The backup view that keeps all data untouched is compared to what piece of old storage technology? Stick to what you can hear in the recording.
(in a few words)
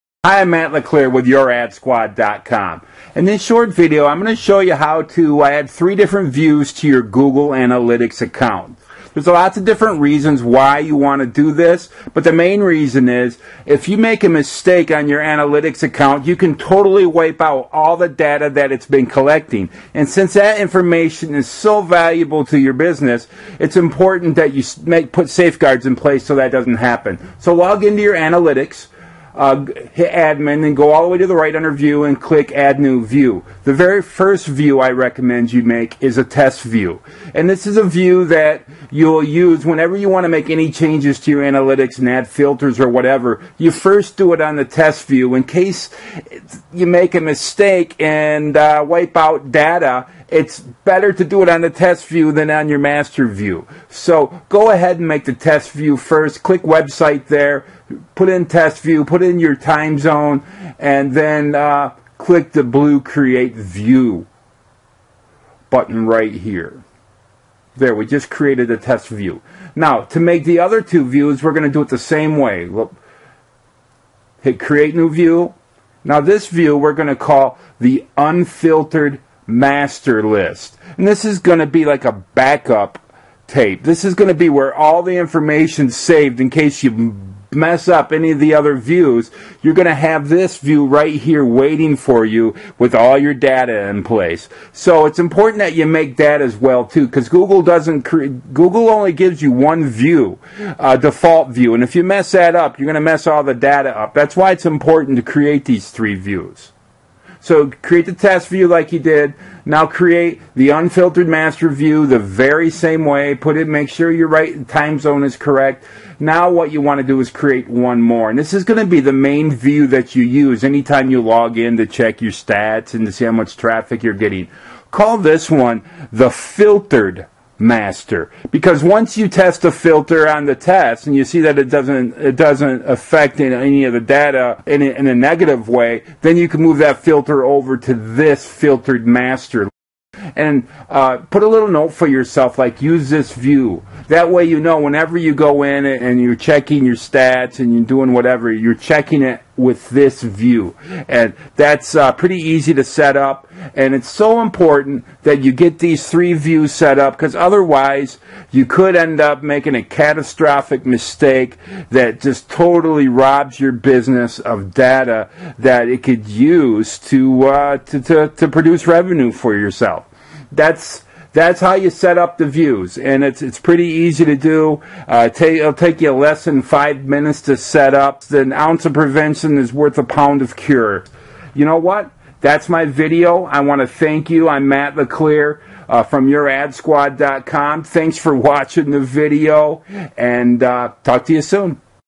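backup tape.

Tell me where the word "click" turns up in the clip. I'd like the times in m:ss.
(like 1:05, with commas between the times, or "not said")
0:32, 0:56, 1:02.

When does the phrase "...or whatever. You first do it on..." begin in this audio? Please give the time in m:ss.
0:42.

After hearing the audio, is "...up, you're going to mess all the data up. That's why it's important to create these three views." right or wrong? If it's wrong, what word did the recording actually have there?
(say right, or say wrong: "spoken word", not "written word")
right.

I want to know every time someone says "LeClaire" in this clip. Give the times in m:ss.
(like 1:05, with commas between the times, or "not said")
0:00, 3:04.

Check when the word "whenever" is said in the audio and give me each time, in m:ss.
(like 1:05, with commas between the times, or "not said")
0:39, 2:24.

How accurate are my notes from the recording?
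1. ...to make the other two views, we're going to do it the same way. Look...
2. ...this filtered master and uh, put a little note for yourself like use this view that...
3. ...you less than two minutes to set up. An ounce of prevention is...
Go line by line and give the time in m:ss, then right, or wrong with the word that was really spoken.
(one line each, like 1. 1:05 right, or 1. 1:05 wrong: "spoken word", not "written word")
1. 1:10 right
2. 2:17 right
3. 2:56 wrong: "five", not "two".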